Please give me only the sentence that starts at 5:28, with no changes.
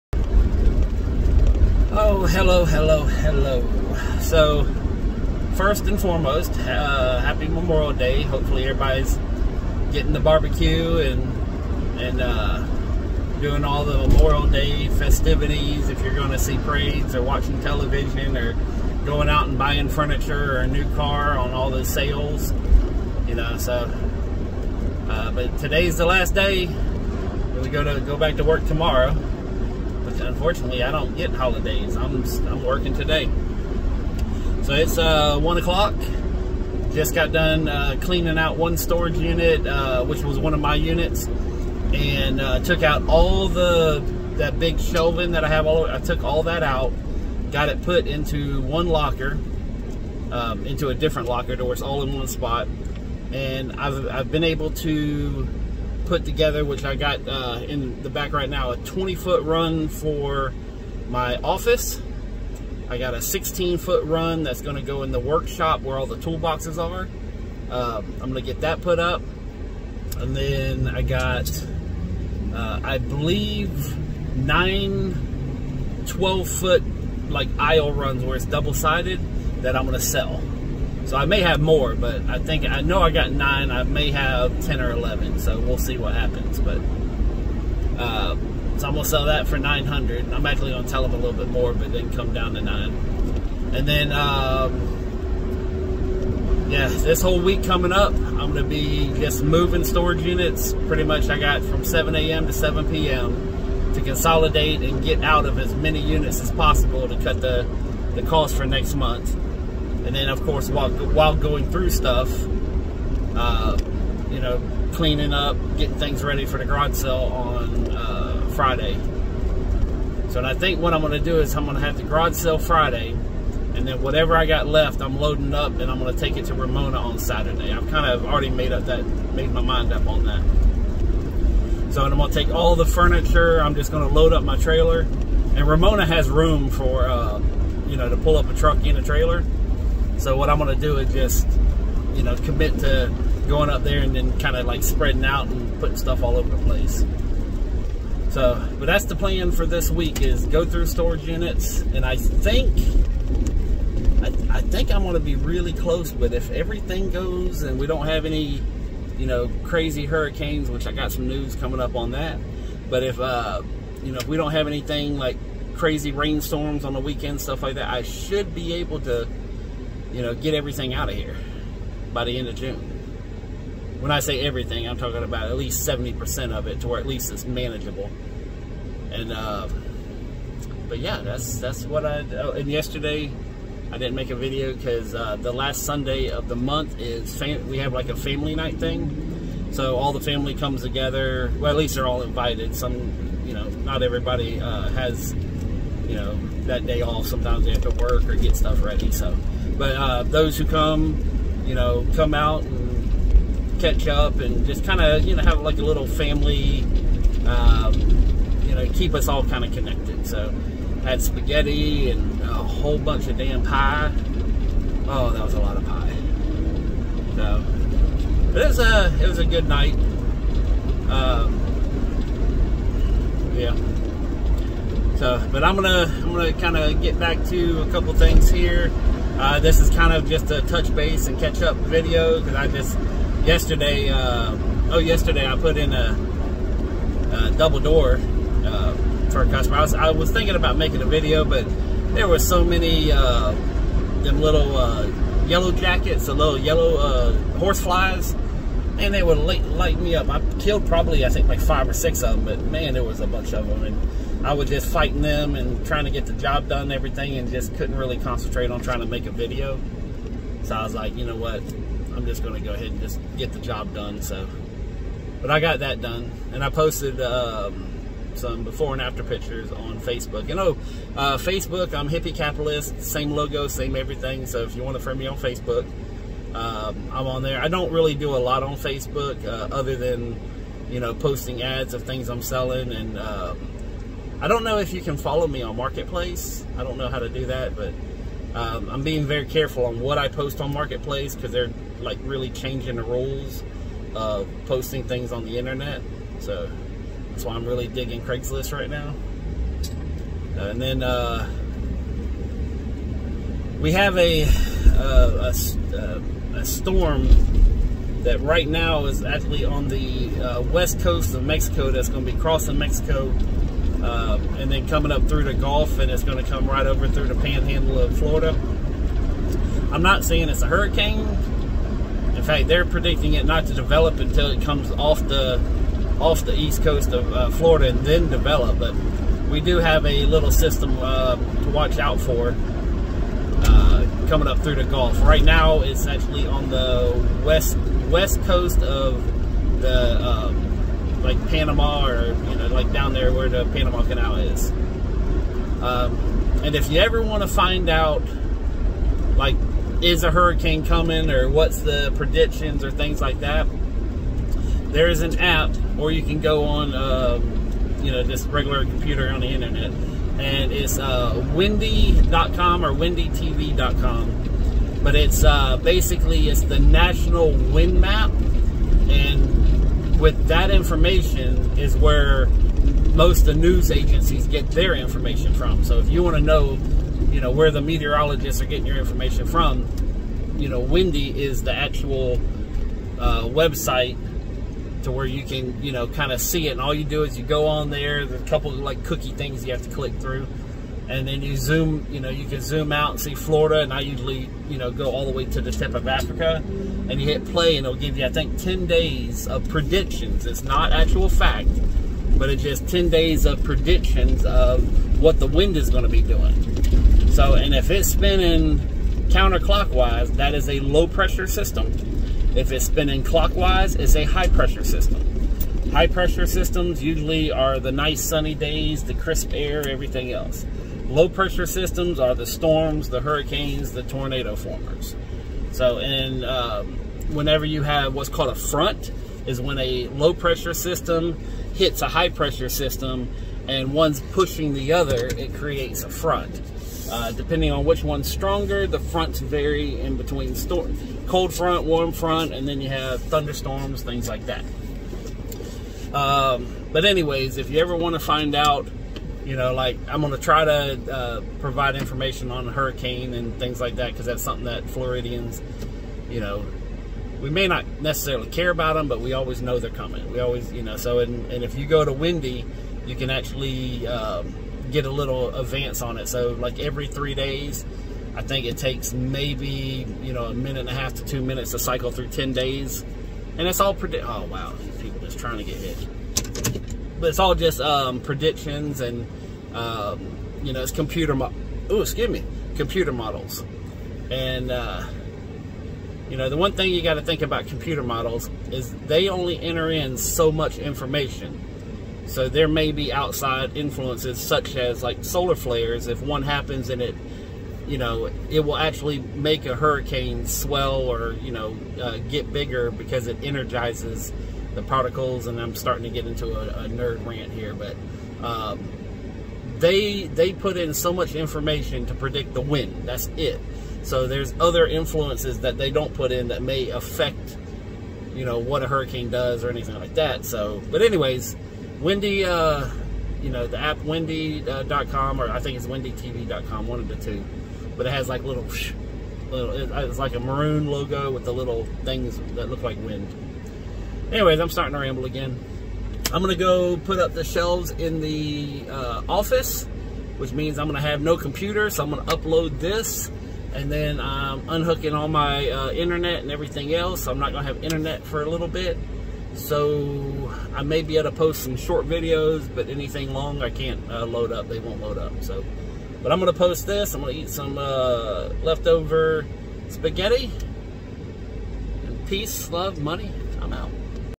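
But we do have a little system uh, to watch out for uh, coming up through the Gulf.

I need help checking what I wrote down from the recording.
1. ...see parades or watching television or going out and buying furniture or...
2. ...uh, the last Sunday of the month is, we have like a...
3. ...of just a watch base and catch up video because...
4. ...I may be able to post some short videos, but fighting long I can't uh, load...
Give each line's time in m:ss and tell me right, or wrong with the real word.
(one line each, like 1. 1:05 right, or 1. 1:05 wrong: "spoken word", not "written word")
1. 0:16 right
2. 3:05 right
3. 3:50 wrong: "touch", not "watch"
4. 9:10 wrong: "anything", not "fighting".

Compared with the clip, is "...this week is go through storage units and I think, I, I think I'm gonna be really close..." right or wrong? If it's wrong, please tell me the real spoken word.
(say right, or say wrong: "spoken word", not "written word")
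right.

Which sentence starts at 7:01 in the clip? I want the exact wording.
Low pressure systems are the storms, the hurricanes, the tornado formers.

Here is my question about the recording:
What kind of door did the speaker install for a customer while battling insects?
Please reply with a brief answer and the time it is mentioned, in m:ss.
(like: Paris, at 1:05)
Double door, at 3:57.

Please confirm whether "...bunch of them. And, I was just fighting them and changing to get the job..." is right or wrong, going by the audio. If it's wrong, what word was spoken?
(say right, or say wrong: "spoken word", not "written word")
wrong: "trying", not "changing".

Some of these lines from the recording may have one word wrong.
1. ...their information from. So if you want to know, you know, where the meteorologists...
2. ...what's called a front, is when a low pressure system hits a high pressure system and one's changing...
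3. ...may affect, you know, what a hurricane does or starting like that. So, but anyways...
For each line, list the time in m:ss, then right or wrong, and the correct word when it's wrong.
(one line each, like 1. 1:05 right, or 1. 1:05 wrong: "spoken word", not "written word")
1. 6:14 right
2. 7:08 wrong: "pushing", not "changing"
3. 8:36 wrong: "anything", not "starting".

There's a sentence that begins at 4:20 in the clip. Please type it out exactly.
So I was like, you know what, I'm just going to go ahead and just get the job done.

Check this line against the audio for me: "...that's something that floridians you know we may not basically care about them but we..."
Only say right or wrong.
wrong.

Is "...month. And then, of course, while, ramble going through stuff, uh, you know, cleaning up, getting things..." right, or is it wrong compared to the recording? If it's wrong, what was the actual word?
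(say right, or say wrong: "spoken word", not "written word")
wrong: "while", not "ramble".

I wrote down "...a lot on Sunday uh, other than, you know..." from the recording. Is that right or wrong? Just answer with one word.
wrong.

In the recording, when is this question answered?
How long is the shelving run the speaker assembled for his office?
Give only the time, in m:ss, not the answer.
0:58.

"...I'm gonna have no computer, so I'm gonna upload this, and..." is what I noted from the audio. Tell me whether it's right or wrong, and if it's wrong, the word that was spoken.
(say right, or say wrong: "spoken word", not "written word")
right.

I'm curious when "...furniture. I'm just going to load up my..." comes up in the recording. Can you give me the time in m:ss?
2:12.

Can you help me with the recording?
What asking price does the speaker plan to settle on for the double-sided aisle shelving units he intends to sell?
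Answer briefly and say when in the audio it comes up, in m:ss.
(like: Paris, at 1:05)
900, at 1:29.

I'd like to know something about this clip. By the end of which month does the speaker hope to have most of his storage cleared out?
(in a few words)
June.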